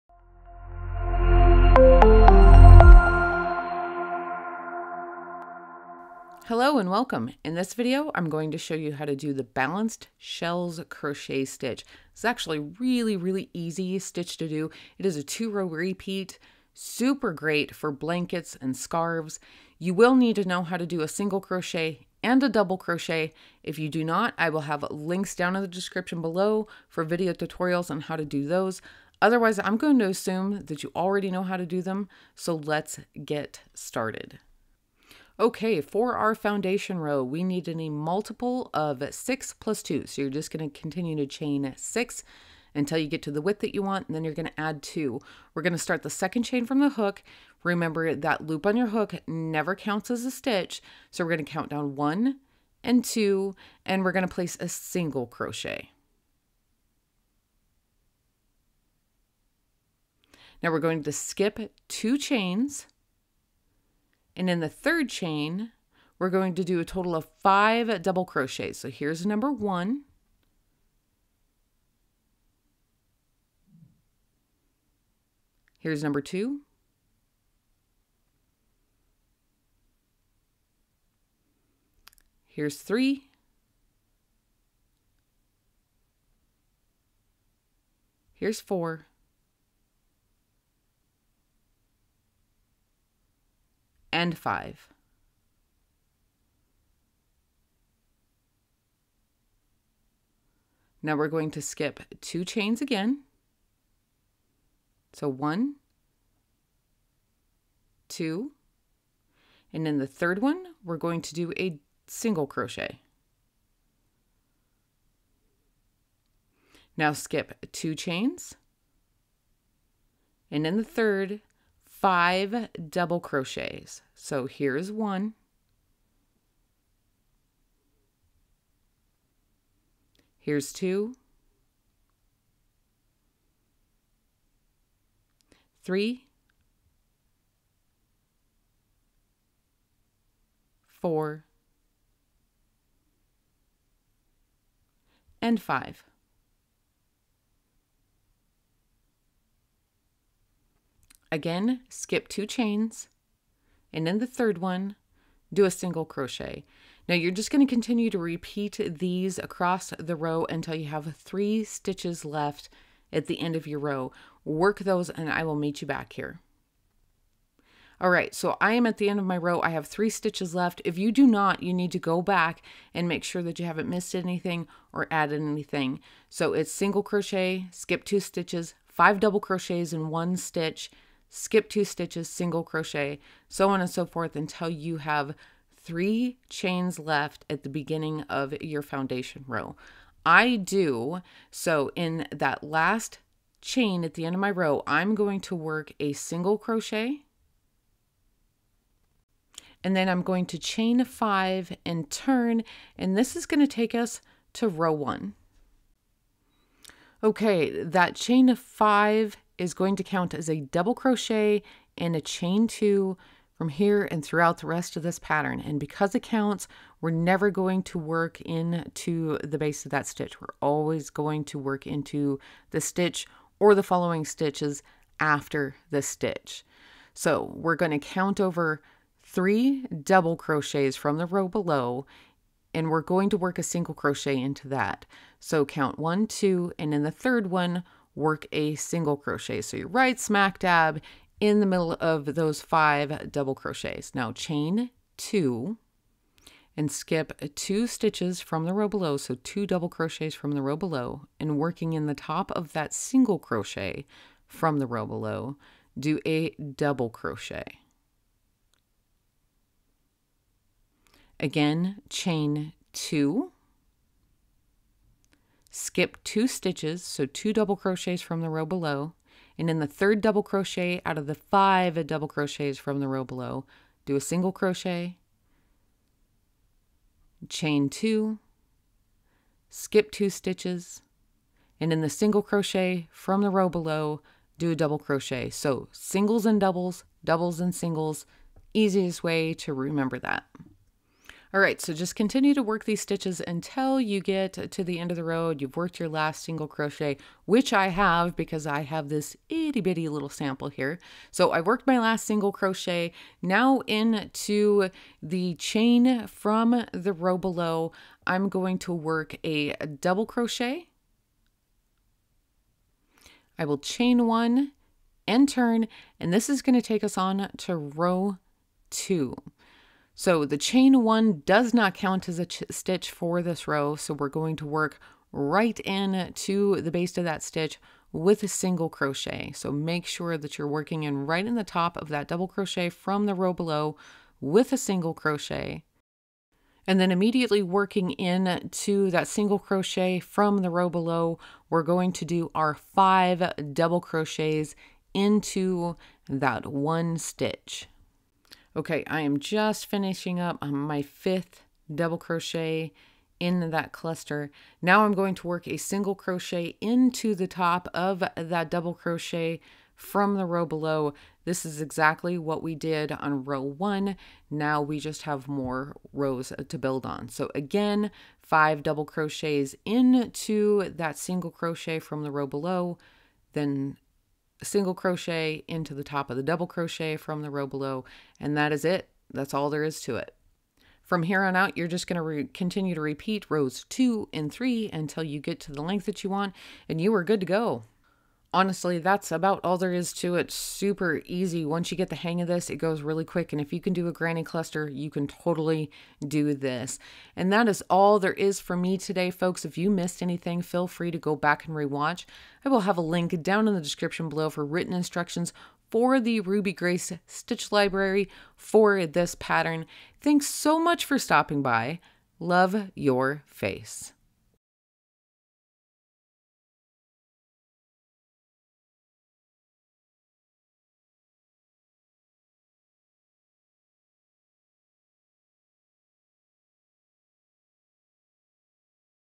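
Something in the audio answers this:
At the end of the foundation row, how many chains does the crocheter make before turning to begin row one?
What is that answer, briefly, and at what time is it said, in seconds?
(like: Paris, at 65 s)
5, at 200 s.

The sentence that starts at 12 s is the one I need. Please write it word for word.
It's actually really, really easy stitch to do.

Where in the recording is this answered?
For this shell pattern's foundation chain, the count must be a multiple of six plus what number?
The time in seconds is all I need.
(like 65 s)
37 s.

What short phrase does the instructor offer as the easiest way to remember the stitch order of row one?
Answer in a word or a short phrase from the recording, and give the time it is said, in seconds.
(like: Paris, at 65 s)
singles and doubles, doubles and singles, at 285 s.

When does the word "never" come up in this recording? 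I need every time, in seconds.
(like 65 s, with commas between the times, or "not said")
49 s, 217 s.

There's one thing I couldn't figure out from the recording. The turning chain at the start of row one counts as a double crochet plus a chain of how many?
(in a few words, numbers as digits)
2.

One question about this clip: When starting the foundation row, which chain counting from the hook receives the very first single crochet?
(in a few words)
second chain.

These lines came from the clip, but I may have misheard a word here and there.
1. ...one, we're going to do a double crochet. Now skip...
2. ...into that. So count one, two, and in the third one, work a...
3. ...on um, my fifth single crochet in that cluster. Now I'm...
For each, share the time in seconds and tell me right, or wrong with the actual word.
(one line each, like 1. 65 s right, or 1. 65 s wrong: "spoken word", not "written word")
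1. 110 s wrong: "single", not "double"
2. 234 s right
3. 350 s wrong: "double", not "single".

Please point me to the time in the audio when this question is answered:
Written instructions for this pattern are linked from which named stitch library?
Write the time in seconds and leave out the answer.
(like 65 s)
406 s.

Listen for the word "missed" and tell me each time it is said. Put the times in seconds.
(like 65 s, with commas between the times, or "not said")
173 s, 399 s.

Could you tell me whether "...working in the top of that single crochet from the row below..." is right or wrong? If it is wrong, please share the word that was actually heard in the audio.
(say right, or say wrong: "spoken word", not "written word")
right.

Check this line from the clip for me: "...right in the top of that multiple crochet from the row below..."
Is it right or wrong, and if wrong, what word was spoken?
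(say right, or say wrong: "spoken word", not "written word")
wrong: "double", not "multiple".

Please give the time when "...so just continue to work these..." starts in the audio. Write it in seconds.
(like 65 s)
291 s.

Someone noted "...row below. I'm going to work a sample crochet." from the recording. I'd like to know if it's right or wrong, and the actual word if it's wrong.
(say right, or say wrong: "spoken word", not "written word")
wrong: "double", not "sample".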